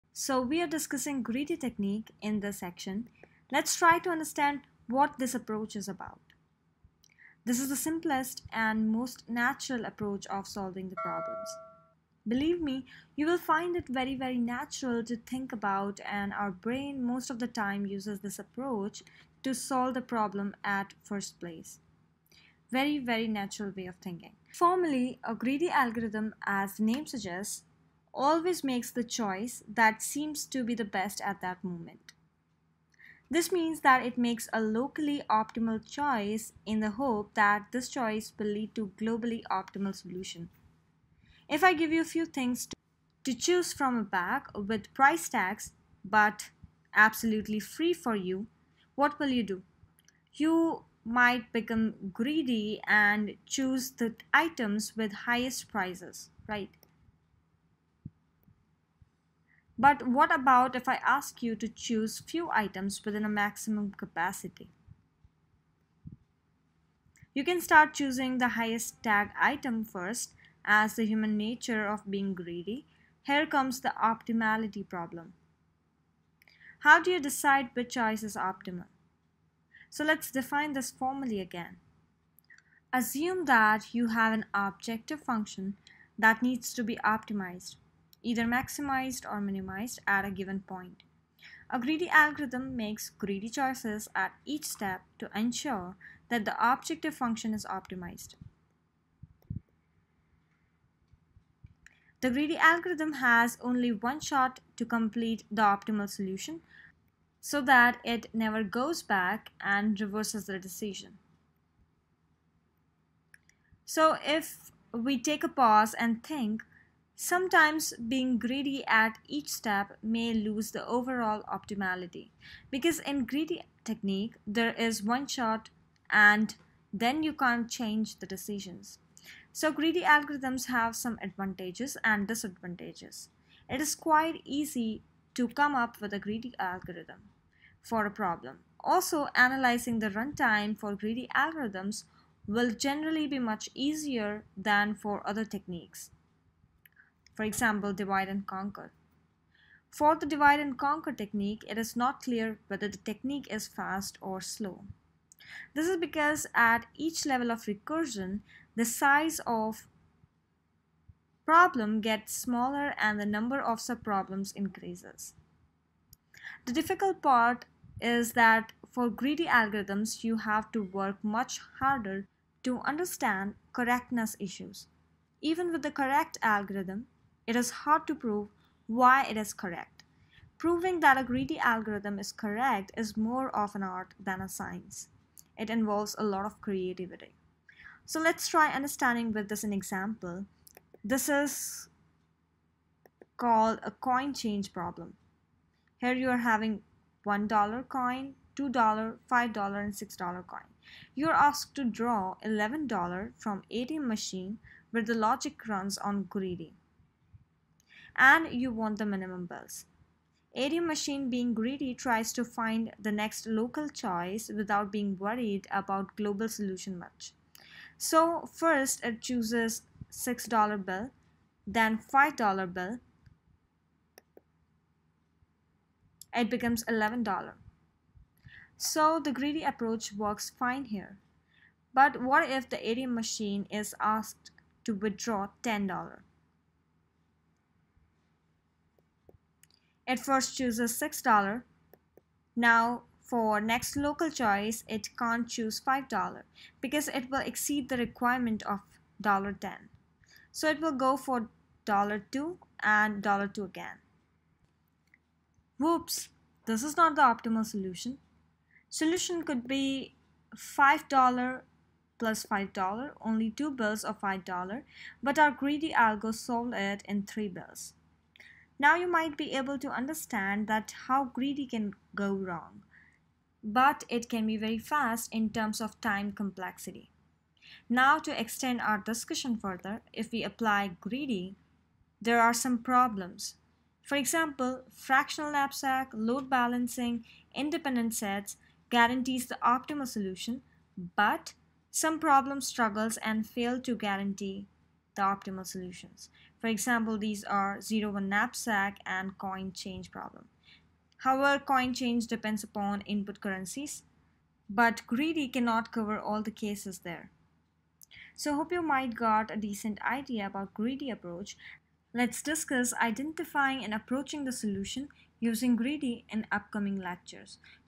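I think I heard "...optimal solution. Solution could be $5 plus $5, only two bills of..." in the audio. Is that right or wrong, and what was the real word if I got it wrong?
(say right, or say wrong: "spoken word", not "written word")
right.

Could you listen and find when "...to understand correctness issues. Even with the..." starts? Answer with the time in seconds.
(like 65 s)
172 s.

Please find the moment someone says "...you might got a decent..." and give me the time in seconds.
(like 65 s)
308 s.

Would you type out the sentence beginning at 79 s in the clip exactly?
So let's define this formally again.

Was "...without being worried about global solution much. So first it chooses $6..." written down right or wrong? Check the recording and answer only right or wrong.
right.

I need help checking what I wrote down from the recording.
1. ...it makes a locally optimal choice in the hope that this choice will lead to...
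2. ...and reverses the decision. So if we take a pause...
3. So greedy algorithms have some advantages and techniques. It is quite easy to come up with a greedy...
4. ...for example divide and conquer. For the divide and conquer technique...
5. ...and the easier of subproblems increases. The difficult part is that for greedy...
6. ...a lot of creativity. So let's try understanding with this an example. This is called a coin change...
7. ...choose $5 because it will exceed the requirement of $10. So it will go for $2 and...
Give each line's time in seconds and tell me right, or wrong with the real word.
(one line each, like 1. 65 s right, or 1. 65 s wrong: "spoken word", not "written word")
1. 34 s right
2. 109 s right
3. 129 s wrong: "disadvantages", not "techniques"
4. 147 s right
5. 162 s wrong: "number", not "easier"
6. 186 s right
7. 245 s right.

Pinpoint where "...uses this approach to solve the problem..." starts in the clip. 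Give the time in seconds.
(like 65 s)
17 s.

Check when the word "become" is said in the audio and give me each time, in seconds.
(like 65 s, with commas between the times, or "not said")
51 s, 226 s.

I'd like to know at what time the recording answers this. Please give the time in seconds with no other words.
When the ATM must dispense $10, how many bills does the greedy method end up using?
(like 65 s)
267 s.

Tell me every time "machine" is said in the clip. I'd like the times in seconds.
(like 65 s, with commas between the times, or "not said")
204 s, 210 s, 233 s.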